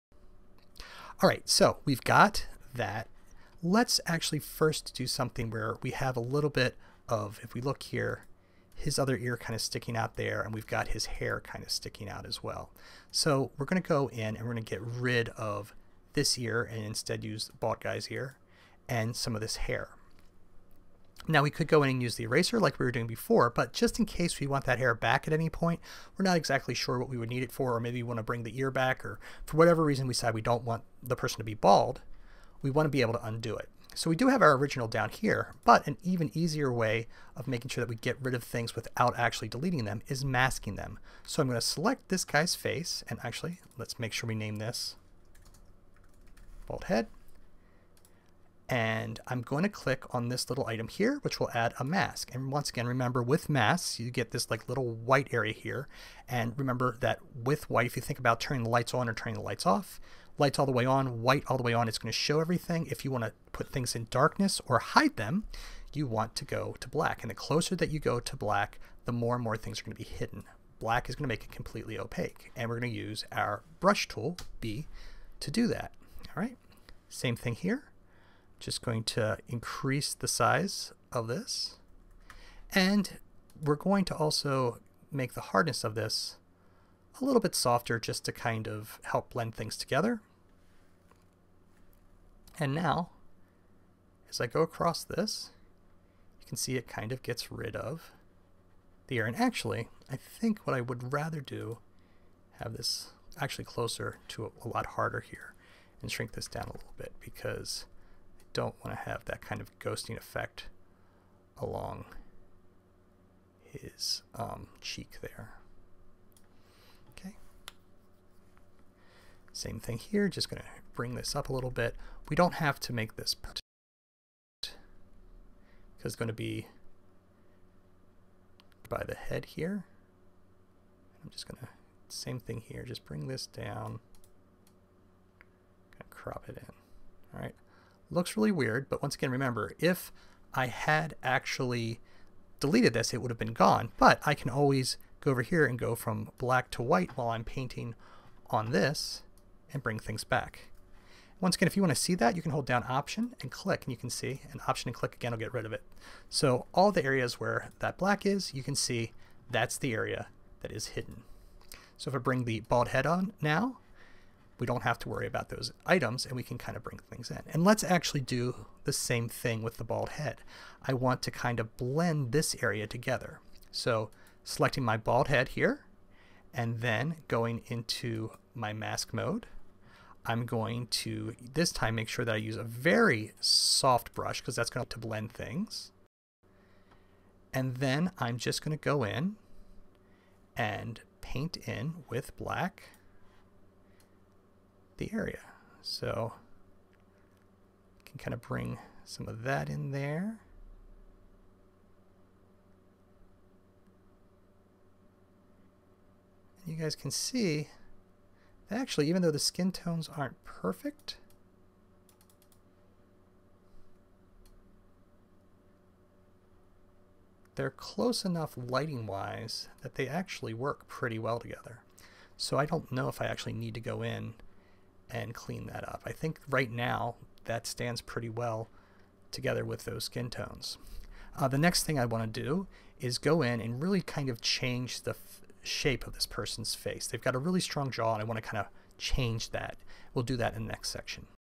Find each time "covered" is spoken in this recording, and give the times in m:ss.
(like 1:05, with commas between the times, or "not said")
not said.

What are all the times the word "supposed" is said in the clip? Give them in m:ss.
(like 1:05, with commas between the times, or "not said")
not said.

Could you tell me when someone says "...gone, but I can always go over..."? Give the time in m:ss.
2:23.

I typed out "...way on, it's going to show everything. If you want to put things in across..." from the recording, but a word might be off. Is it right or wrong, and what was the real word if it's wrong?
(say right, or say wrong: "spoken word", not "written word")
wrong: "darkness", not "across".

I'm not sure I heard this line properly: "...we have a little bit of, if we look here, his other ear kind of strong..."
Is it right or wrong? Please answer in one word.
wrong.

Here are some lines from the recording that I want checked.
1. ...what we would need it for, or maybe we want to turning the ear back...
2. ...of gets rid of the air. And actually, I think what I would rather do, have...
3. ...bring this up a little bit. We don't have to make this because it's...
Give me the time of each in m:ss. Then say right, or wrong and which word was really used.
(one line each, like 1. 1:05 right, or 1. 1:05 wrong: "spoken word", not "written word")
1. 0:26 wrong: "bring", not "turning"
2. 1:37 right
3. 2:00 right.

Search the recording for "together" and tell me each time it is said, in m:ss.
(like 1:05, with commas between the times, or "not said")
1:29, 2:52, 3:41, 3:49.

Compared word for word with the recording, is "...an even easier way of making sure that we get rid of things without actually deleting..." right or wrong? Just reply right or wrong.
right.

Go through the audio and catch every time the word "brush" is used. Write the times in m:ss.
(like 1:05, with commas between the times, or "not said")
1:13, 3:04.